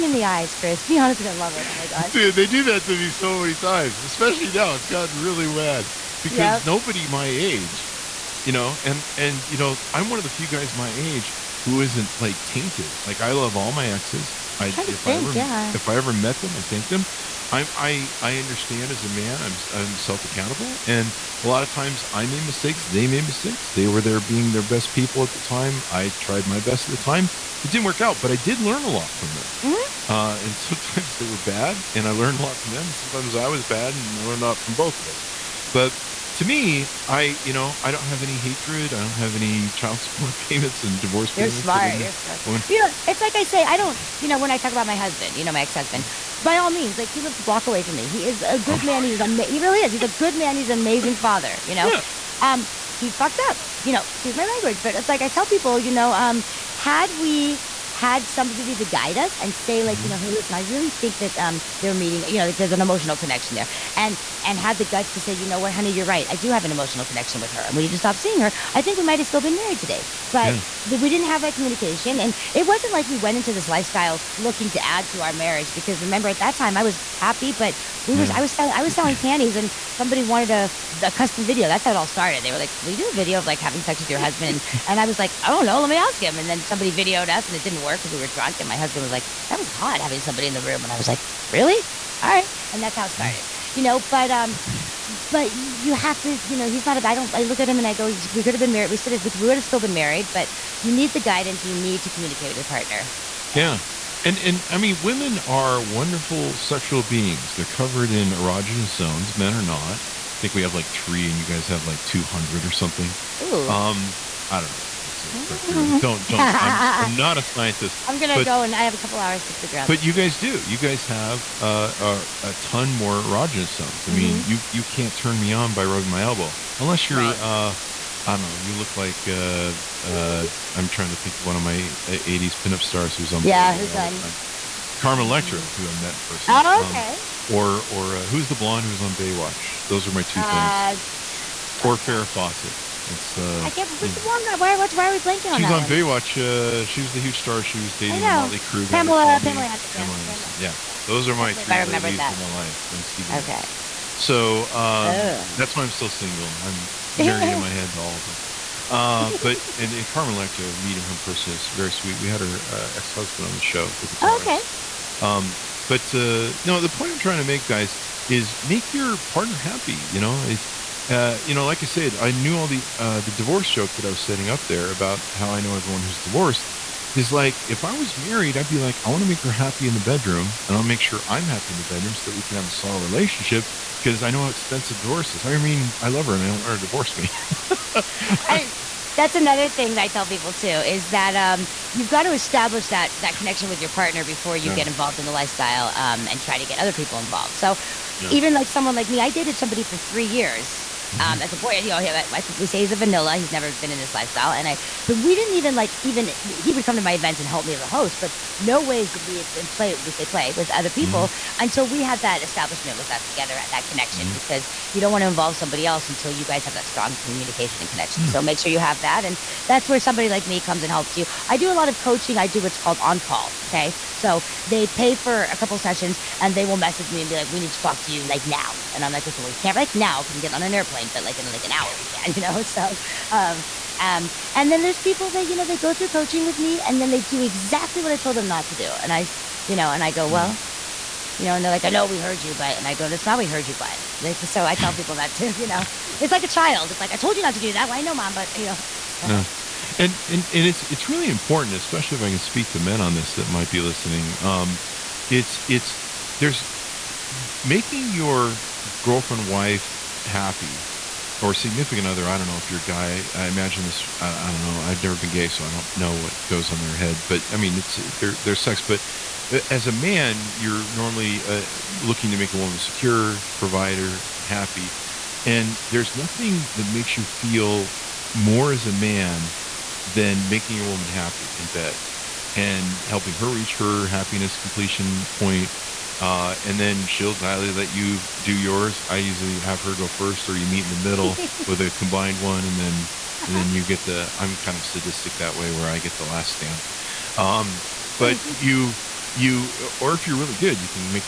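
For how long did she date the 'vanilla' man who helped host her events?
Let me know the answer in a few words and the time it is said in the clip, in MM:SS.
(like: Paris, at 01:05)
3 years, at 03:19.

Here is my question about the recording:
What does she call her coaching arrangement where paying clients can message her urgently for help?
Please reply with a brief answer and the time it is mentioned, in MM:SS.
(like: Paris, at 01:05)
On call, at 03:43.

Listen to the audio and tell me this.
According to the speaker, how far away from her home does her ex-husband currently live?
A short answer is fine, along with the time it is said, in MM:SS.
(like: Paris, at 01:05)
A block away, at 00:47.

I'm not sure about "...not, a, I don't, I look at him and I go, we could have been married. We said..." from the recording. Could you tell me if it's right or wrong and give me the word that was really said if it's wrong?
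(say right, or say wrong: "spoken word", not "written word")
right.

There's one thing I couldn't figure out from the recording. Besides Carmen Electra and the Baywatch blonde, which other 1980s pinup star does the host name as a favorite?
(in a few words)
Farrah Fawcett.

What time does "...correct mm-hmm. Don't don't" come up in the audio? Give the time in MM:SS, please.
01:55.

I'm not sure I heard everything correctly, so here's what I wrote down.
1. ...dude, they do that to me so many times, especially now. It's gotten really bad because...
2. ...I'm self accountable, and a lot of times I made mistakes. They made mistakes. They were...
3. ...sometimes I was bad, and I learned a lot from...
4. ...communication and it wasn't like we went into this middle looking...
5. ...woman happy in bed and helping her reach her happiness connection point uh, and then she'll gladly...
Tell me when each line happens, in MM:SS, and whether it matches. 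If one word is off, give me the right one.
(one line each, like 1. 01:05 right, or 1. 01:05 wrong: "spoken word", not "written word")
1. 00:02 right
2. 00:19 right
3. 00:32 right
4. 01:11 wrong: "lifestyle", not "middle"
5. 04:40 wrong: "completion", not "connection".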